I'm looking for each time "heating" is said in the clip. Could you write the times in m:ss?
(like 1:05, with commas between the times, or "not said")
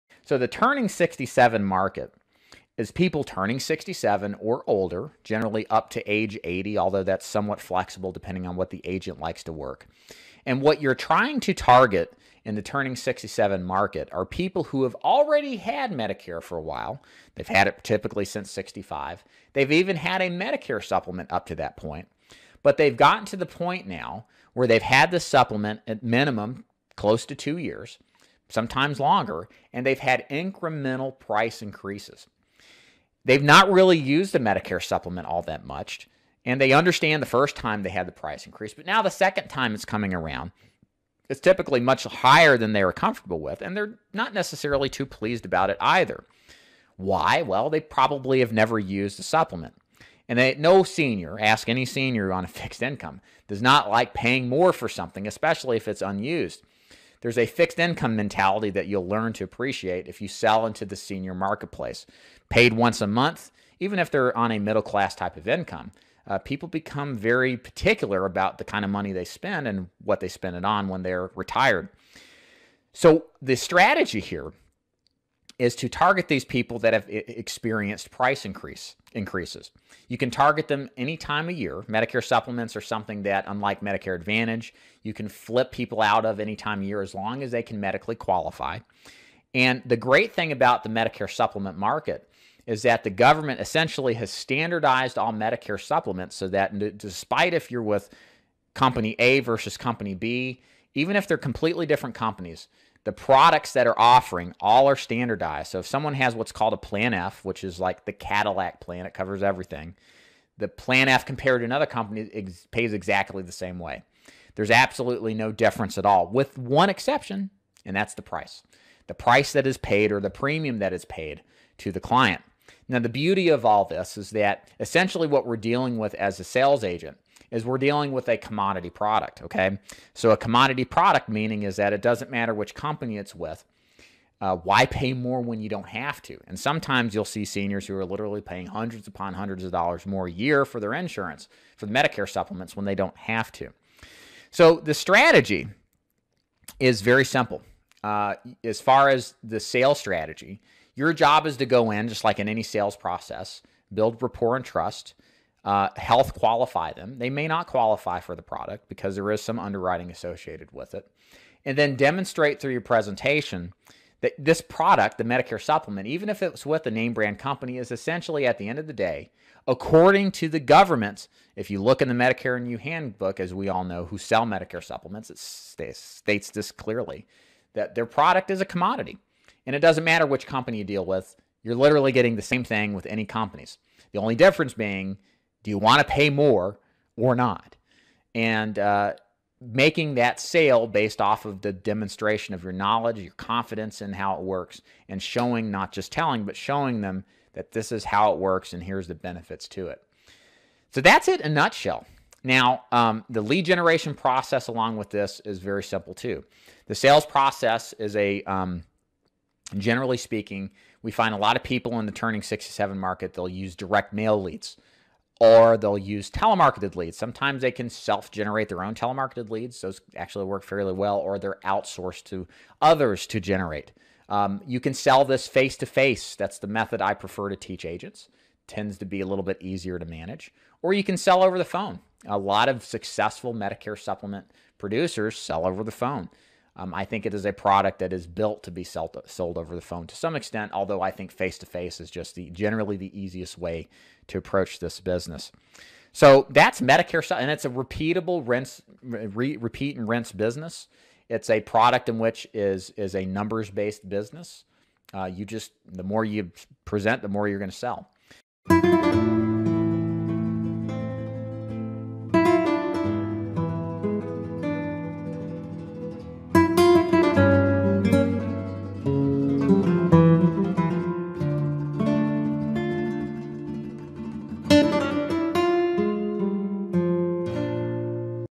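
not said.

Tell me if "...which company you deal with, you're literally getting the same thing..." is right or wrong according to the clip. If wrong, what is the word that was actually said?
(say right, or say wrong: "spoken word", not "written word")
right.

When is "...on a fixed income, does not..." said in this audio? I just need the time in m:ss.
0:52.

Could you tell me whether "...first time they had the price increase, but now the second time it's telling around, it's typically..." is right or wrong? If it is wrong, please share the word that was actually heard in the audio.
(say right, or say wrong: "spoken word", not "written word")
wrong: "coming", not "telling".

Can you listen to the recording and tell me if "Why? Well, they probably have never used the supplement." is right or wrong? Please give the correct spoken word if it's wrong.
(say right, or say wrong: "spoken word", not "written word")
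right.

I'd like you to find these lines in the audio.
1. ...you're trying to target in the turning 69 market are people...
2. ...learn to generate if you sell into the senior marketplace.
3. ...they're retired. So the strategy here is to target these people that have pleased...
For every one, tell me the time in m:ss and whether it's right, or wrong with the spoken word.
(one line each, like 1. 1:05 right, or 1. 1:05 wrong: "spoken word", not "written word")
1. 0:10 wrong: "67", not "69"
2. 0:59 wrong: "appreciate", not "generate"
3. 1:11 wrong: "experienced", not "pleased".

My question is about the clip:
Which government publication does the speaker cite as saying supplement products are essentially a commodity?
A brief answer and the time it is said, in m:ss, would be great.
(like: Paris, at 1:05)
Medicare and You, at 2:52.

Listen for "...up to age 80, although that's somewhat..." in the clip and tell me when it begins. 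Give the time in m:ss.
0:05.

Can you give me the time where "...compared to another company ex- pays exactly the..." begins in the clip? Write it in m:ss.
1:51.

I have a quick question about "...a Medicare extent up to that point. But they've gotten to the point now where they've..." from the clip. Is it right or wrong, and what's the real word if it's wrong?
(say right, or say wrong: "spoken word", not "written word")
wrong: "supplement", not "extent".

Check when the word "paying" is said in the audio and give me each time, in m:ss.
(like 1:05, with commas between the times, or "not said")
0:54, 2:18.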